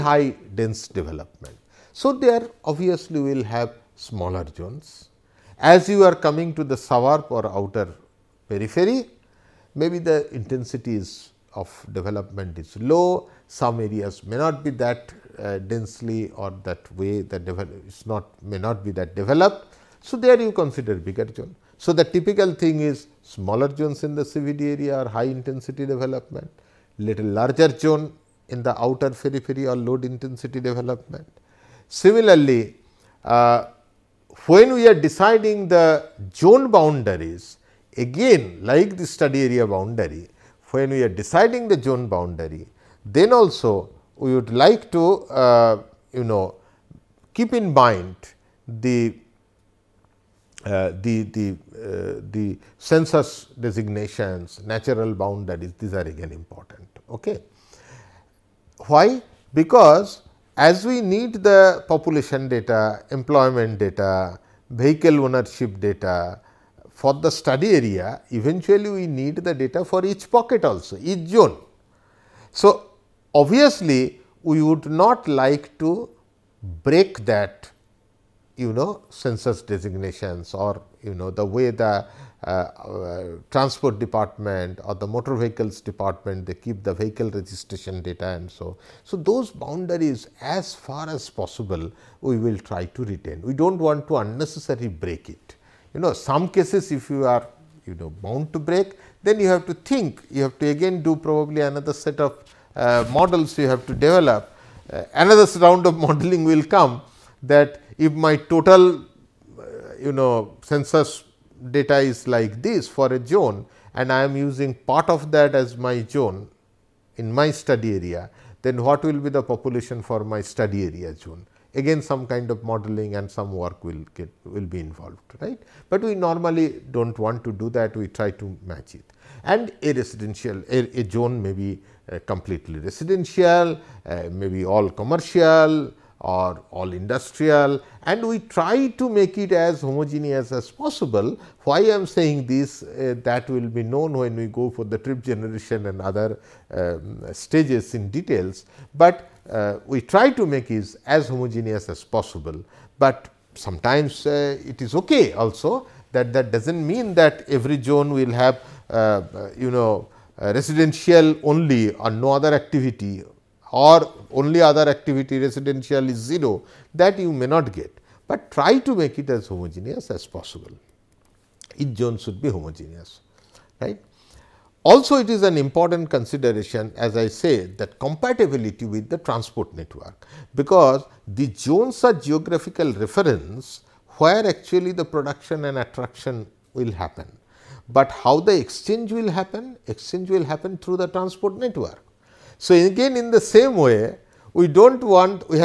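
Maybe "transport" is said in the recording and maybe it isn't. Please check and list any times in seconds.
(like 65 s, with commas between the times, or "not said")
83 s, 179 s, 191 s.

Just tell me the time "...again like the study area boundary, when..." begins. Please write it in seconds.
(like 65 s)
37 s.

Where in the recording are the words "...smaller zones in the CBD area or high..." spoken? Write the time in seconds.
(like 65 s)
23 s.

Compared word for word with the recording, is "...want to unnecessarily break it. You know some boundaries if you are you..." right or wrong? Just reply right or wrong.
wrong.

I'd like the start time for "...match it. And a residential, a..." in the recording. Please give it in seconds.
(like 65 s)
128 s.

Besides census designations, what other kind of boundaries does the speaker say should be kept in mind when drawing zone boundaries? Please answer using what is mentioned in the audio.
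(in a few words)
Natural boundaries.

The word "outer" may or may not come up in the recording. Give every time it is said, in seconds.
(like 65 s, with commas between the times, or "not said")
7 s, 28 s.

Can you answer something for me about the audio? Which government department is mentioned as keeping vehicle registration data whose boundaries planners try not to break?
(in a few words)
Motor vehicles department.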